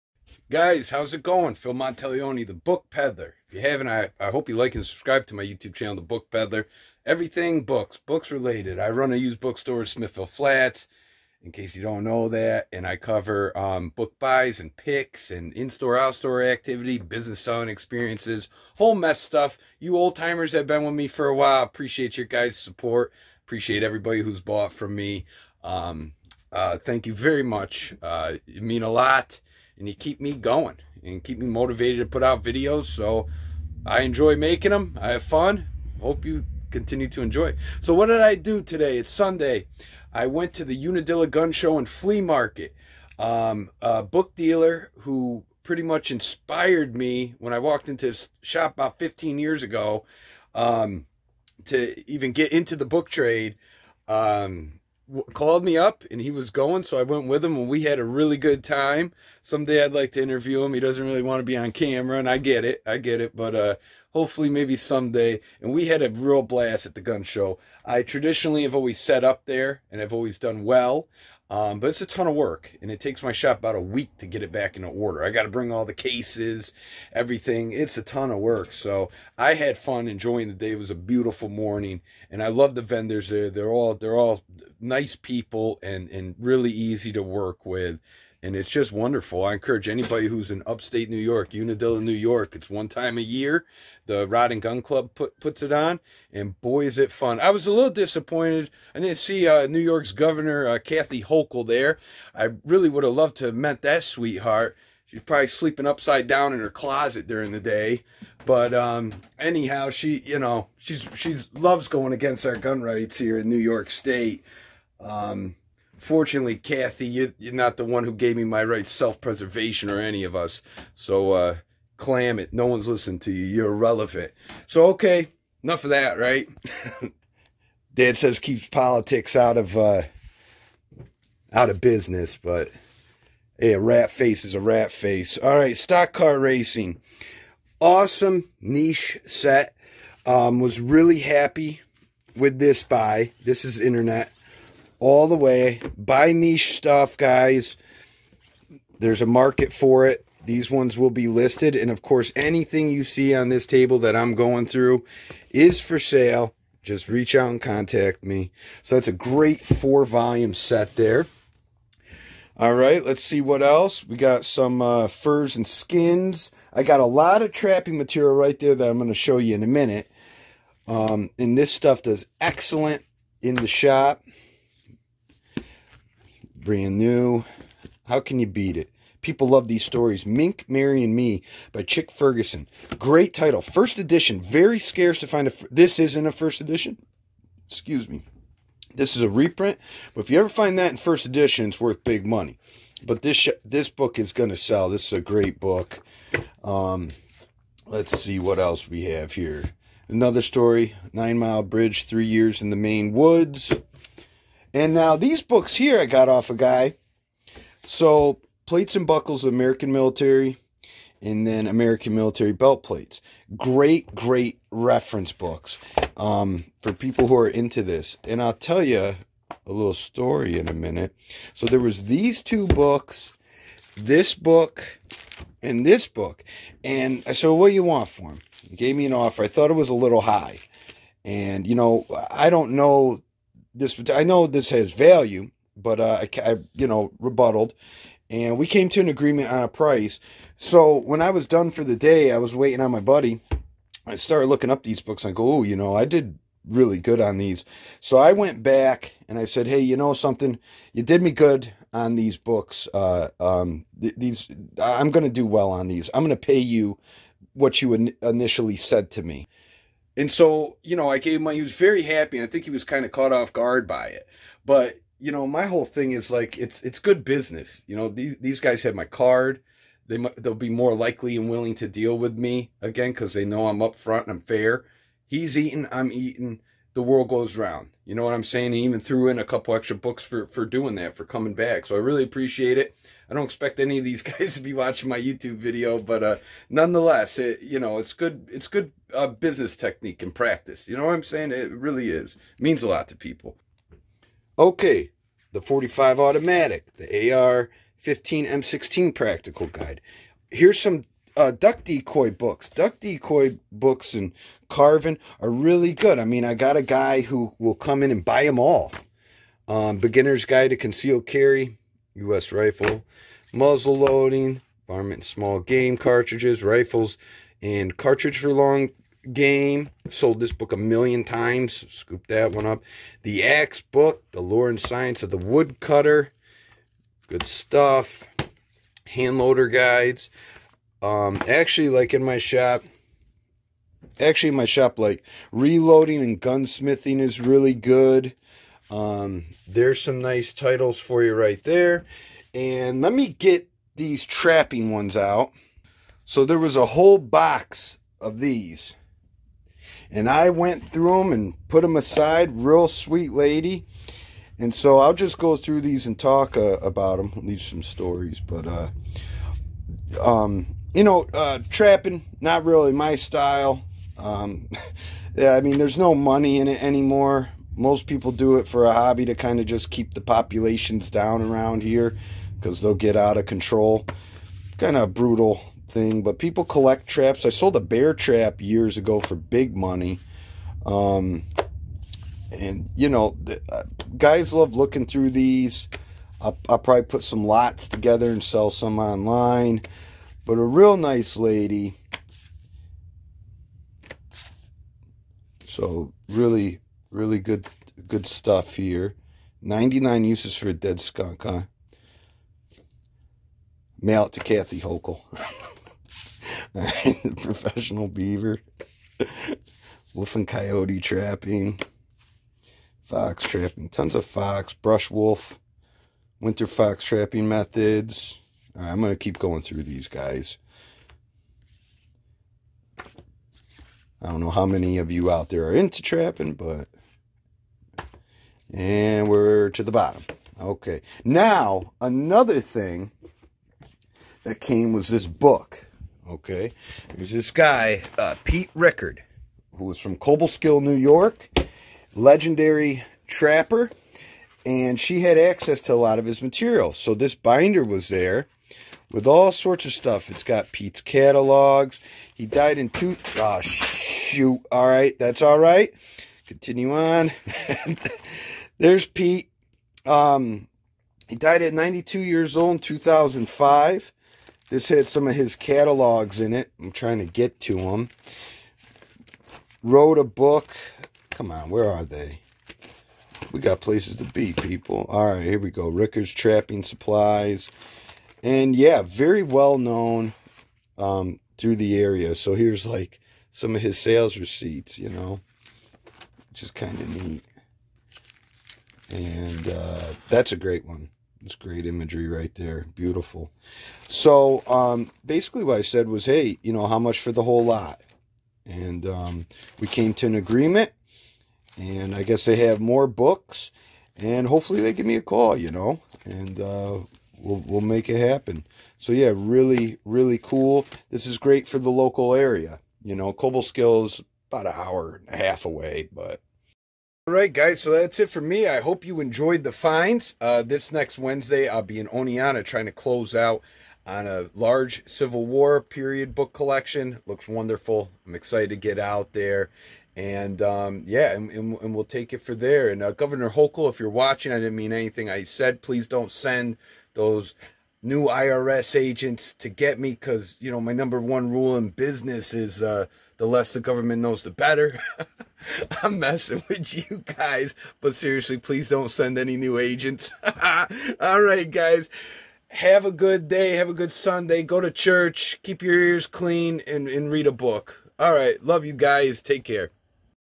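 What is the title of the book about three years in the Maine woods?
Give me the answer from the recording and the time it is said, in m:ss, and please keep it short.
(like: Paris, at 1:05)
Nine Mile Bridge, at 3:21.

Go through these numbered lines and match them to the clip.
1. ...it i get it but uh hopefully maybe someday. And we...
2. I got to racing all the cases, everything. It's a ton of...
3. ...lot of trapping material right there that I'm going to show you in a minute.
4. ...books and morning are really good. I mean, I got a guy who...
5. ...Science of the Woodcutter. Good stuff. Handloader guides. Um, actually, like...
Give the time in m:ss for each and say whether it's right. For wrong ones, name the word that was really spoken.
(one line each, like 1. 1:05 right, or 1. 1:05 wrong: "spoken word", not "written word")
1. 1:02 right
2. 1:15 wrong: "bring", not "racing"
3. 2:47 right
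4. 5:03 wrong: "carving", not "morning"
5. 5:24 right.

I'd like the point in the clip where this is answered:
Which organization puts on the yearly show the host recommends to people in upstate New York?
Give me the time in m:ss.
1:34.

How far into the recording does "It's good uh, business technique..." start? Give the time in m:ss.
4:48.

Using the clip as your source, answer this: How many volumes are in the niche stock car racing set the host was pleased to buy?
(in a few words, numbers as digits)
4.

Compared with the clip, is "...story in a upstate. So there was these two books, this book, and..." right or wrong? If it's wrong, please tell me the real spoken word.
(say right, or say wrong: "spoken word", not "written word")
wrong: "minute", not "upstate".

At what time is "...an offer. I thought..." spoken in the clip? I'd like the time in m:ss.
3:49.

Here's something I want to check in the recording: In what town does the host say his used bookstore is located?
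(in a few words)
Smithville Flats.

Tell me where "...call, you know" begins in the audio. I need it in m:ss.
8:25.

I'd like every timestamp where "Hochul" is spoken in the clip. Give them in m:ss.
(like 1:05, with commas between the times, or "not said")
1:41, 6:44, 8:53.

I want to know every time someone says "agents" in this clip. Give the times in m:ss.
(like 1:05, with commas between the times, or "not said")
8:58, 9:09.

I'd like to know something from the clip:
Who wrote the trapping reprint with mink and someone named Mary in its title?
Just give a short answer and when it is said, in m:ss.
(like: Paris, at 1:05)
Chick Ferguson, at 3:01.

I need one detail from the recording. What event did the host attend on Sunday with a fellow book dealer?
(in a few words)
Unadilla Gun Show and Flea Market.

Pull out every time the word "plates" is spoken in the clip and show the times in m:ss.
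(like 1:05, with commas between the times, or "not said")
3:28, 3:32.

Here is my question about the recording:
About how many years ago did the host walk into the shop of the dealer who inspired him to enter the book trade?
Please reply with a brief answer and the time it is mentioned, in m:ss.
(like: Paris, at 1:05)
15, at 0:48.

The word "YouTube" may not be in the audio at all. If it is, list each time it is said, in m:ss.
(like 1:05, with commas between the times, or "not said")
0:05, 4:45.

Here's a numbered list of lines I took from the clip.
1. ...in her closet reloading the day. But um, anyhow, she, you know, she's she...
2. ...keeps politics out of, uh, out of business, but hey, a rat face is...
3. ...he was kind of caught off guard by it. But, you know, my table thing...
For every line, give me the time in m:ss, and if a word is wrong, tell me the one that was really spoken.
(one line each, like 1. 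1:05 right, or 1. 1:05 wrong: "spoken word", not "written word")
1. 1:46 wrong: "during", not "reloading"
2. 2:08 right
3. 4:22 wrong: "whole", not "table".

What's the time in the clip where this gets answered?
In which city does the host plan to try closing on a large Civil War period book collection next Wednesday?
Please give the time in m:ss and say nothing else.
8:42.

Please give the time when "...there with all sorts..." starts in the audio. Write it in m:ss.
7:28.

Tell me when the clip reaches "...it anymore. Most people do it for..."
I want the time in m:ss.
6:06.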